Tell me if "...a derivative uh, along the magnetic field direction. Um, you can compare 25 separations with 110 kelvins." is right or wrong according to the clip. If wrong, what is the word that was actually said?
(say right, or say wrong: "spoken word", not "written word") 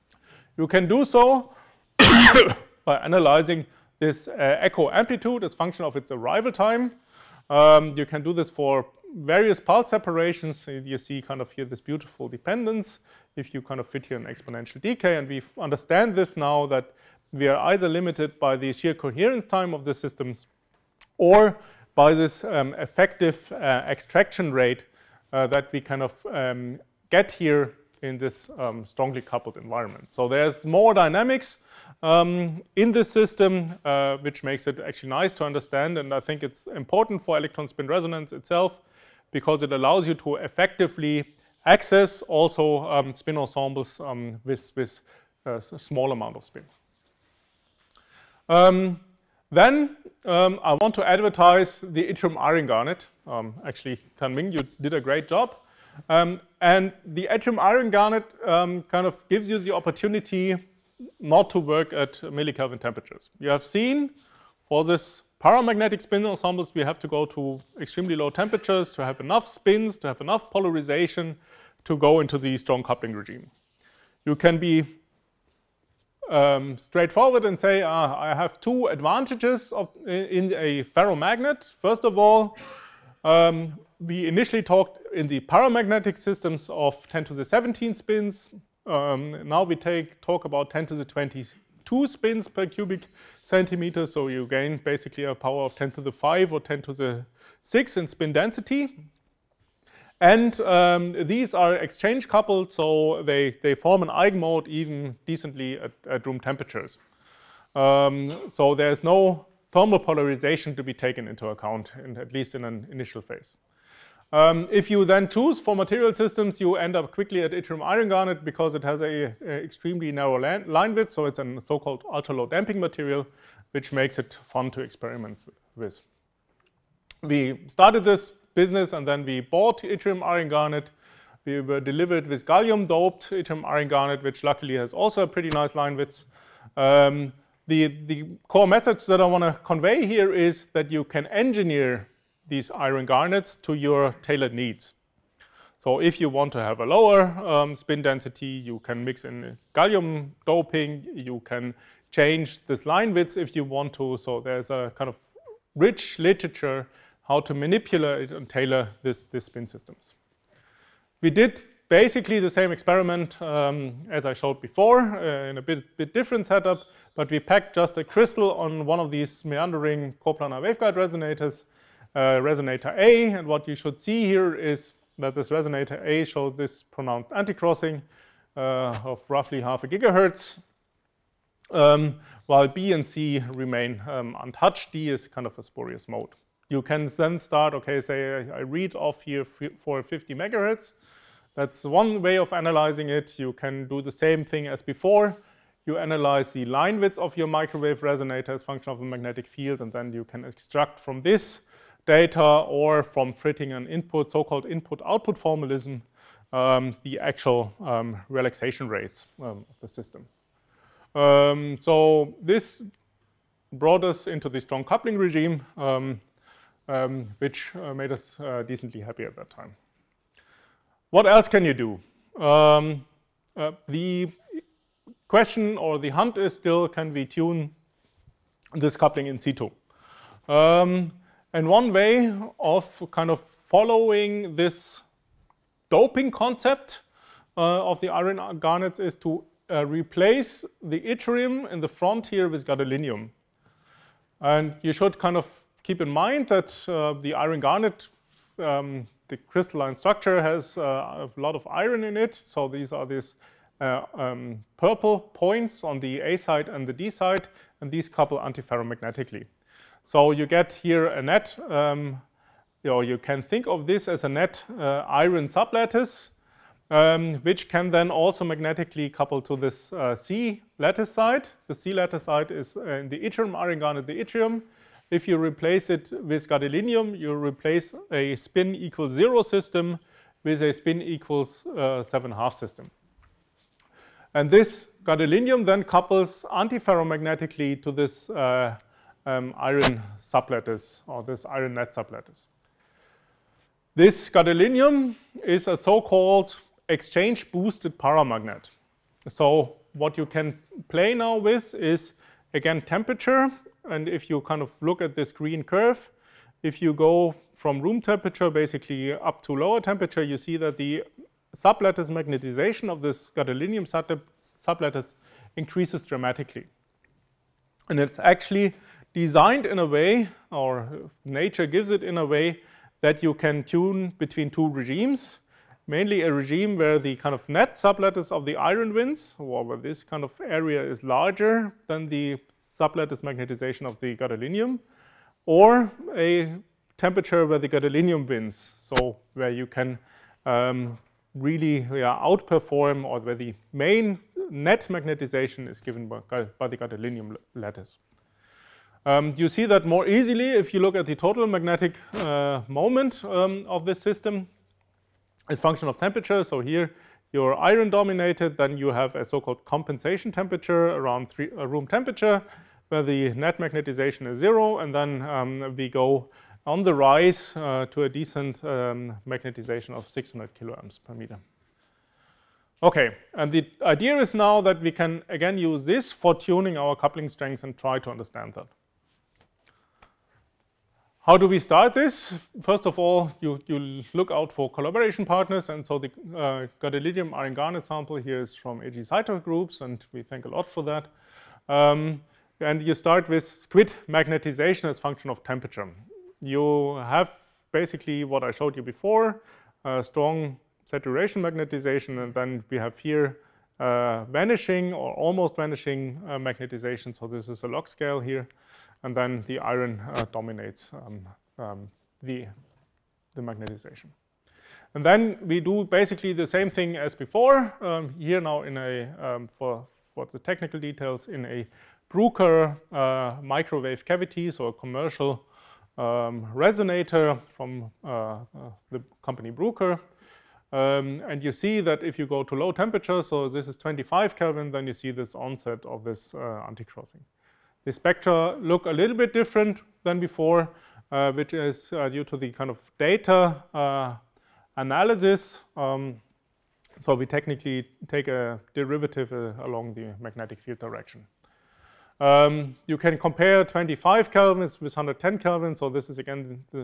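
wrong: "kelvins", not "separations".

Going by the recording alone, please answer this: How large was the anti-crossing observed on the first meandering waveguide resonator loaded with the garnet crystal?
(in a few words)
Half a gigahertz.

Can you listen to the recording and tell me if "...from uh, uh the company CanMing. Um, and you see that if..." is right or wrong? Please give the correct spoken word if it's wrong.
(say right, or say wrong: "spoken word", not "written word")
wrong: "Bruker", not "CanMing".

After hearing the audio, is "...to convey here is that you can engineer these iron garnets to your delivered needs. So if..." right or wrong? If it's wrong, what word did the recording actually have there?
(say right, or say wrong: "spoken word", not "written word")
wrong: "tailored", not "delivered".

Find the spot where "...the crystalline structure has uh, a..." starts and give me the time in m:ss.
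4:09.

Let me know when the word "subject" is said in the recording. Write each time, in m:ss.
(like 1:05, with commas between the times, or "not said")
not said.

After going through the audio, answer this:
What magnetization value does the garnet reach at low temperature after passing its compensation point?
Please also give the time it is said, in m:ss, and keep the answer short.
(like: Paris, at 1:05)
600 kA/m, at 6:10.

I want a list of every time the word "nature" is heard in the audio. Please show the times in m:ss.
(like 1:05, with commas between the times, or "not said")
5:21.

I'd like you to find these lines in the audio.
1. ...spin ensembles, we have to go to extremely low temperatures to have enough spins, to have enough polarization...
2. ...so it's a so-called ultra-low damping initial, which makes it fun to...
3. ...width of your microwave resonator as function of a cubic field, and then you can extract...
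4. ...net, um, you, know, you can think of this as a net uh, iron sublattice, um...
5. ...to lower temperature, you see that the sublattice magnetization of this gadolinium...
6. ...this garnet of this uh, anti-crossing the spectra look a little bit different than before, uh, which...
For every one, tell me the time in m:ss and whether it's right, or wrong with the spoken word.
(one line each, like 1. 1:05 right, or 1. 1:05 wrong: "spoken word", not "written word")
1. 1:05 right
2. 2:01 wrong: "material", not "initial"
3. 3:16 wrong: "magnetic", not "cubic"
4. 4:21 right
5. 5:09 right
6. 7:15 wrong: "onset", not "garnet".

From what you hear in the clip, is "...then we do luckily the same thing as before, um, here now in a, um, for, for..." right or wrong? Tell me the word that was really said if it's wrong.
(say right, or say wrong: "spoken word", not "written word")
wrong: "basically", not "luckily".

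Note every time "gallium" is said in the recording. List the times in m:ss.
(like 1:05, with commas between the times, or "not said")
2:12, 2:29.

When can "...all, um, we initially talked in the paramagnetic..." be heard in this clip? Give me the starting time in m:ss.
1:22.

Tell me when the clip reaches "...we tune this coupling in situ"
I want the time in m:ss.
3:47.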